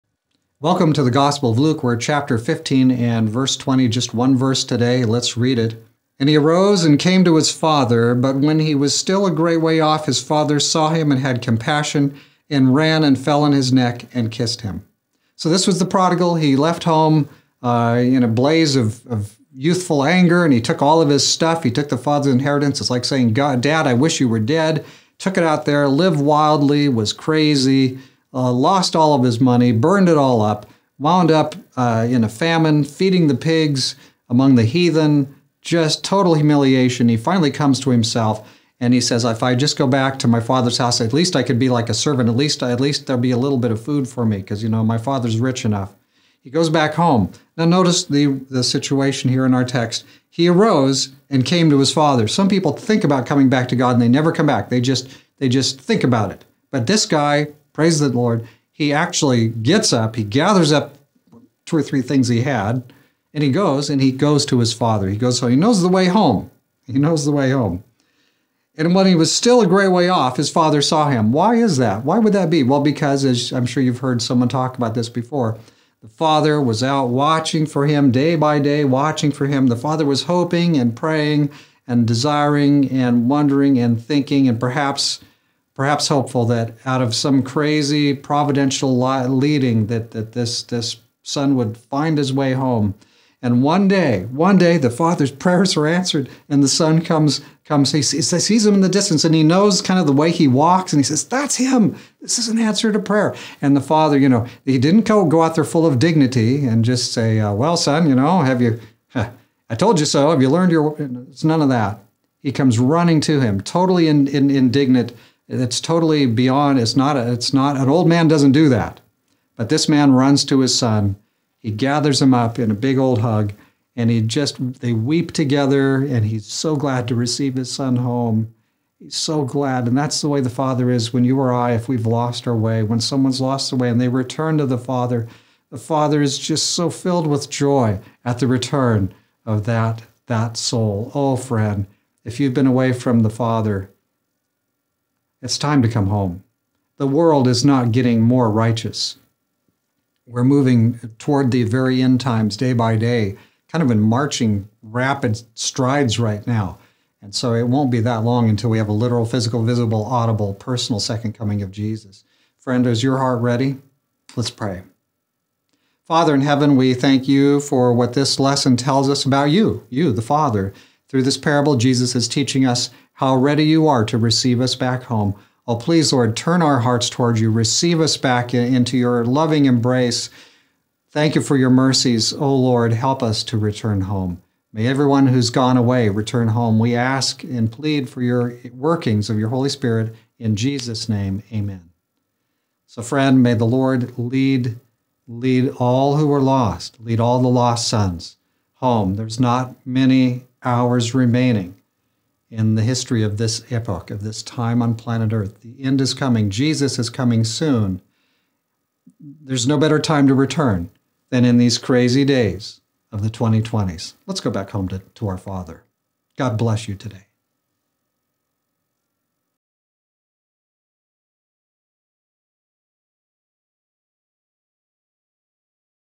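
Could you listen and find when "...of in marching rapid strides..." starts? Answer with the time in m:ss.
2:33.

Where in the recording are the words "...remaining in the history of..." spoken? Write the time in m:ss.
3:21.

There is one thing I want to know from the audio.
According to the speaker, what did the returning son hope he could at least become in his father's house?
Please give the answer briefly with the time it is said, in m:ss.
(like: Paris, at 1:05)
a servant, at 0:41.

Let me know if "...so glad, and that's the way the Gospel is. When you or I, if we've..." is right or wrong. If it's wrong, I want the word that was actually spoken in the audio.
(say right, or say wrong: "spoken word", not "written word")
wrong: "Father", not "Gospel".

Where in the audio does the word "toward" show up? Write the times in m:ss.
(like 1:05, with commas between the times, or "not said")
2:31, 2:57.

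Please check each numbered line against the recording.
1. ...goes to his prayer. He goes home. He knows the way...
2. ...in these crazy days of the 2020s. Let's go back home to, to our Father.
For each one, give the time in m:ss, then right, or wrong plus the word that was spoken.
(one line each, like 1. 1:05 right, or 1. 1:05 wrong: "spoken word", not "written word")
1. 1:04 wrong: "father", not "prayer"
2. 3:31 right.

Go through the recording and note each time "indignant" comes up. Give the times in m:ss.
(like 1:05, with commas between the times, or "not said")
1:54.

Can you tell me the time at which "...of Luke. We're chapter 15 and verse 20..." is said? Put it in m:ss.
0:01.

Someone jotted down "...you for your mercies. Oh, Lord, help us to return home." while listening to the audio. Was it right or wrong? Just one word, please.
right.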